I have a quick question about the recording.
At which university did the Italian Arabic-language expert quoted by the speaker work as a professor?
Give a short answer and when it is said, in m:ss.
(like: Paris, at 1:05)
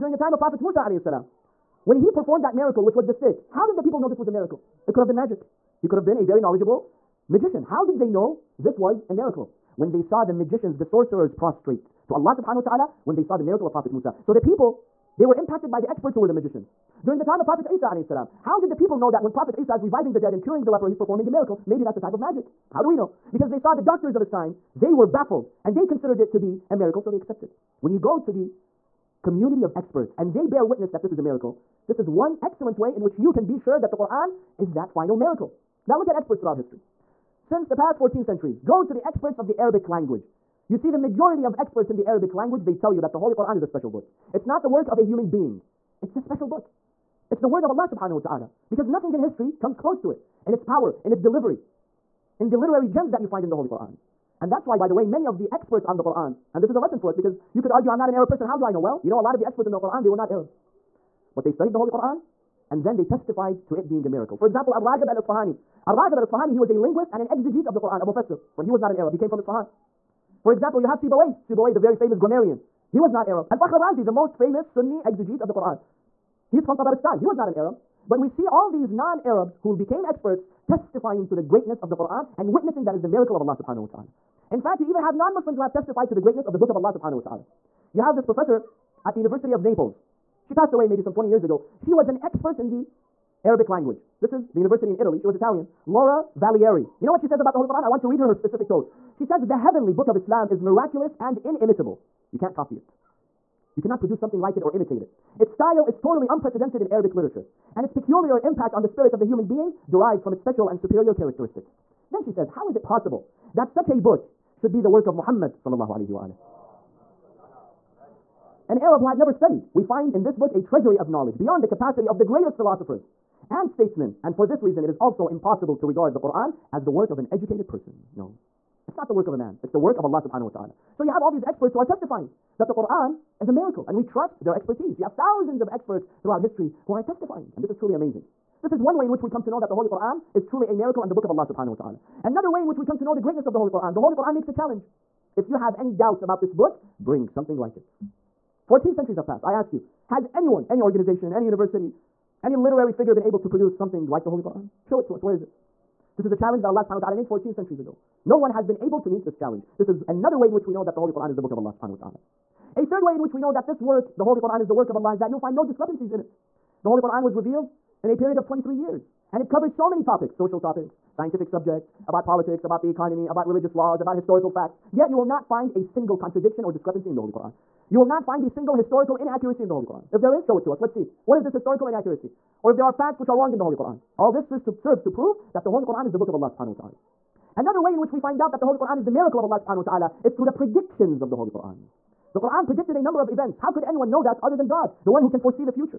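University of Naples, at 1:29.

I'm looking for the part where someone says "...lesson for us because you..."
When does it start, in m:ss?
0:56.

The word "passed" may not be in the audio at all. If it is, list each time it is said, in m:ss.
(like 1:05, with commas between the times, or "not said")
1:30, 2:29.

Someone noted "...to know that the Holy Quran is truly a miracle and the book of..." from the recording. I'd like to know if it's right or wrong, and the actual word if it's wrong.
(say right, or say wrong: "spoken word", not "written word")
right.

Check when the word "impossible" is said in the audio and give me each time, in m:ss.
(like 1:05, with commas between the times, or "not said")
2:05.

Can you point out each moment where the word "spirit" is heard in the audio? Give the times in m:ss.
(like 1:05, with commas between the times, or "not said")
1:48.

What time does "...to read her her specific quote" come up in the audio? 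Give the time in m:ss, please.
1:38.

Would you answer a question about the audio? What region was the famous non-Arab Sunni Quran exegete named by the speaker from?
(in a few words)
Tabaristan.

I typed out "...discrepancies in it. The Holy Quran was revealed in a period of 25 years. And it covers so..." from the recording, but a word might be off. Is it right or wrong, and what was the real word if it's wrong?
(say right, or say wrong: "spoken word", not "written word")
wrong: "23", not "25".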